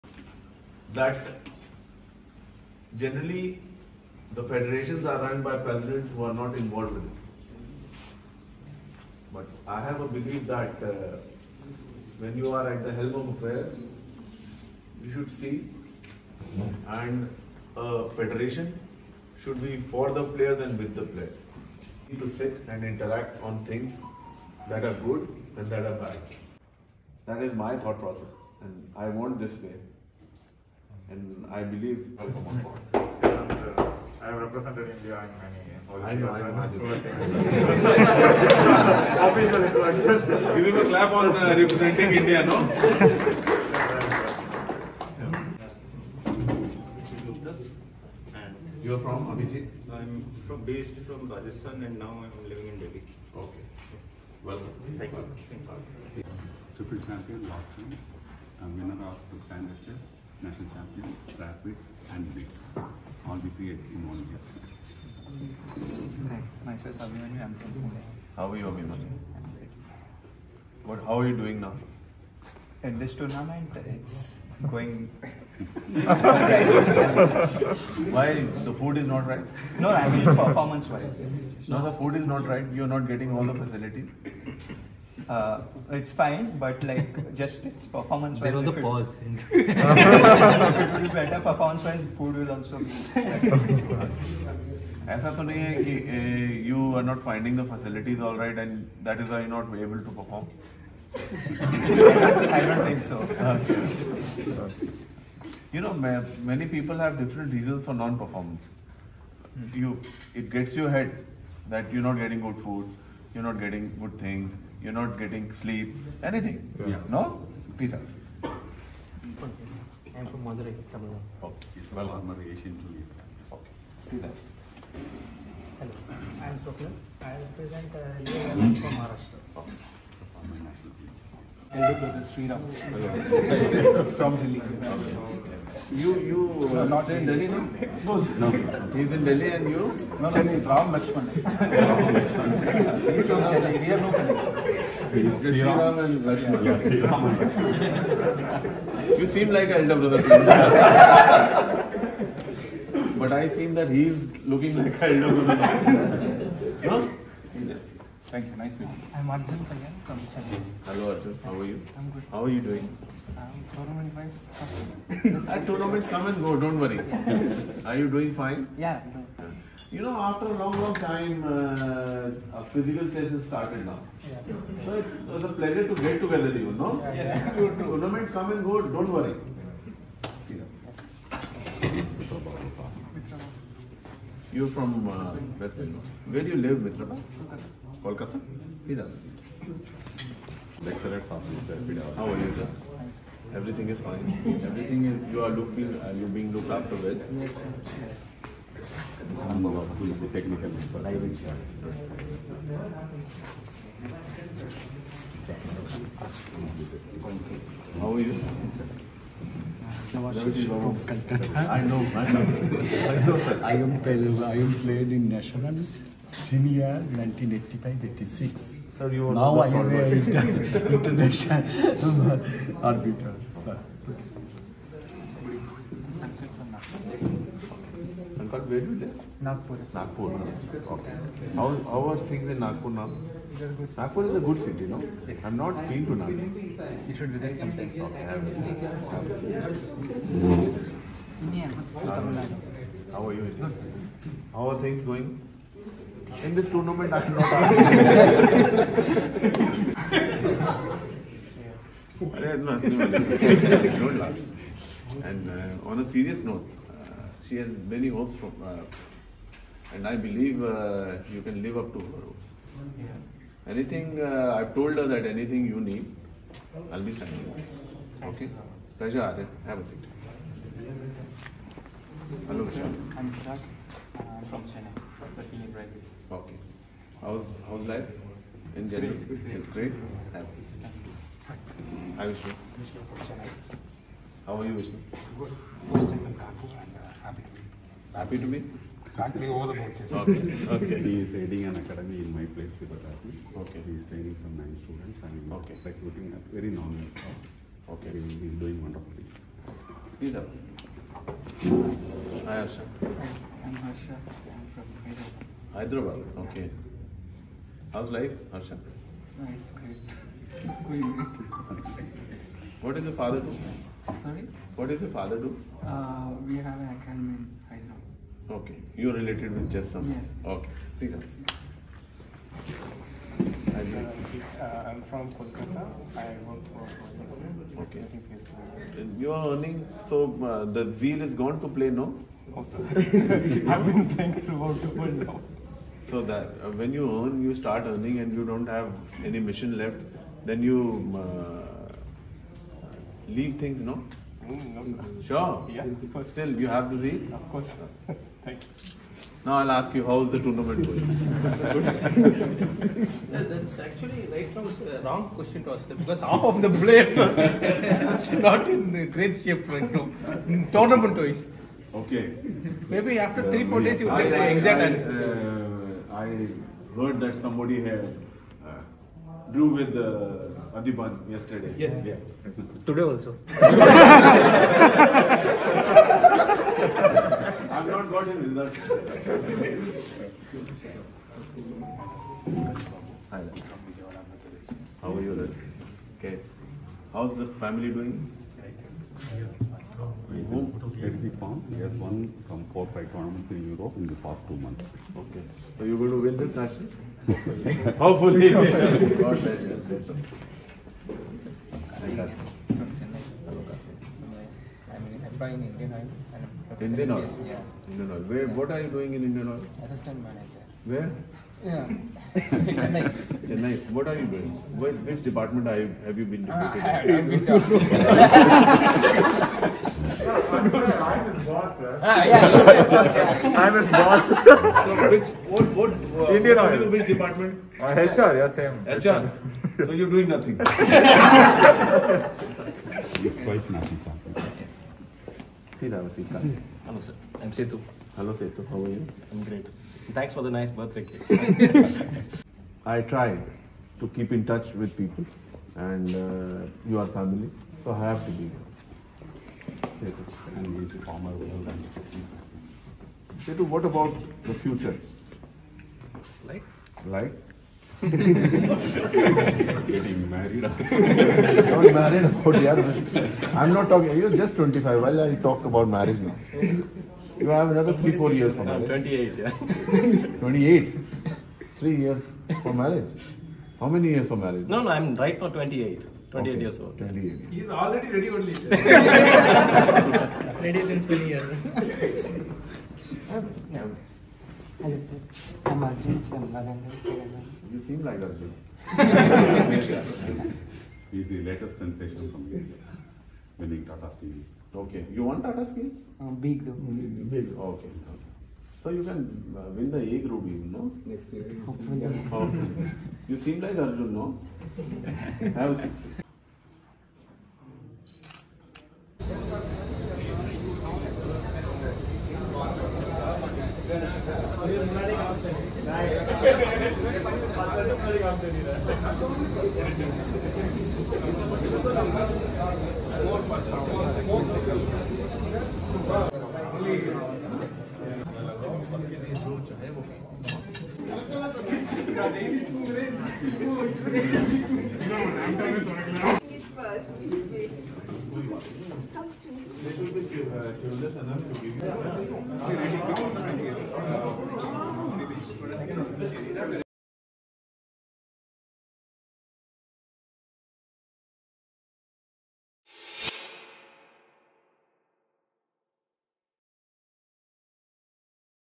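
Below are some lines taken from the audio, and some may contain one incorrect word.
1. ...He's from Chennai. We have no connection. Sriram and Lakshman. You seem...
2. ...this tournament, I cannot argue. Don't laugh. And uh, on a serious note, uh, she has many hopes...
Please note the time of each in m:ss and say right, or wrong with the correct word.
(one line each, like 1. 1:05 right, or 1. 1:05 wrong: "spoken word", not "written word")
1. 2:23 right
2. 4:06 right.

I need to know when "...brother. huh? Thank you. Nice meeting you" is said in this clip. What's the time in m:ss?
2:35.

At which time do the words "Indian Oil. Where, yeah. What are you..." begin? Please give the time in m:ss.
6:47.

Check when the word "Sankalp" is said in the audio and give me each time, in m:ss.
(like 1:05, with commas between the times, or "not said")
3:48.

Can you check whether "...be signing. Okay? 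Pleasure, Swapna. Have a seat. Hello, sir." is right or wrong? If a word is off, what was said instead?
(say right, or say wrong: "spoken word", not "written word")
wrong: "Arya", not "Swapna".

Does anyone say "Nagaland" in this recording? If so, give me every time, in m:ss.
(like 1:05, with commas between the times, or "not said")
8:06.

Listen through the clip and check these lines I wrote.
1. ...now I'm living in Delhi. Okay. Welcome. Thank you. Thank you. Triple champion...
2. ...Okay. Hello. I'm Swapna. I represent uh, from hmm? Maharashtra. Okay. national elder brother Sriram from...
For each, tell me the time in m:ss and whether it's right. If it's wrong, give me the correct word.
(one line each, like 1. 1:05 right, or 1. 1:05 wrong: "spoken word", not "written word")
1. 0:51 right
2. 2:03 right.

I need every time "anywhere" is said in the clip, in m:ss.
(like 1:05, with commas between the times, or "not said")
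not said.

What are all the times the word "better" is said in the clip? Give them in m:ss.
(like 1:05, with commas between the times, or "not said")
1:31.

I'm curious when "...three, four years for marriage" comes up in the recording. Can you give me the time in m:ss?
7:47.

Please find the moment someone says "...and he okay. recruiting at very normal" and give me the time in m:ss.
4:55.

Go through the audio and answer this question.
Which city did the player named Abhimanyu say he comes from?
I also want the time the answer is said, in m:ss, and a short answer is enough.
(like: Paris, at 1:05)
Pune, at 1:07.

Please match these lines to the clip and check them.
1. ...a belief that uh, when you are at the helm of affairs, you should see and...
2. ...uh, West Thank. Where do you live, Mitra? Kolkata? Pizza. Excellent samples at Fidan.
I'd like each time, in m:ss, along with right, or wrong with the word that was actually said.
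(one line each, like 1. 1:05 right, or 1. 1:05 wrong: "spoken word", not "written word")
1. 0:10 right
2. 3:05 wrong: "Bengal", not "Thank".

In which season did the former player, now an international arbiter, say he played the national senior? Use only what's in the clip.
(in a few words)
1985-86.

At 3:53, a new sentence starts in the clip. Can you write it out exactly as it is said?
Nagpur is a good city, no?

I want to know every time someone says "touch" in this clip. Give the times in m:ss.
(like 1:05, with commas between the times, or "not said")
7:24.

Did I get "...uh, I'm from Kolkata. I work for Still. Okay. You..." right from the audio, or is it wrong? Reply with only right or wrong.
wrong.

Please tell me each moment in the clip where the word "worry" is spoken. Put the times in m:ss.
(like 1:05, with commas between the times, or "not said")
2:46, 2:59.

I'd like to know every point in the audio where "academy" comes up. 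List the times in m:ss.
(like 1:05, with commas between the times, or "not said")
4:51, 5:17.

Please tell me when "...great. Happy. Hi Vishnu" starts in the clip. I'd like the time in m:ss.
4:39.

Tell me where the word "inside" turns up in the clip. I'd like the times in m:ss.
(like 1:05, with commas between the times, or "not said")
not said.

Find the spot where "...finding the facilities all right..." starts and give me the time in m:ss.
1:37.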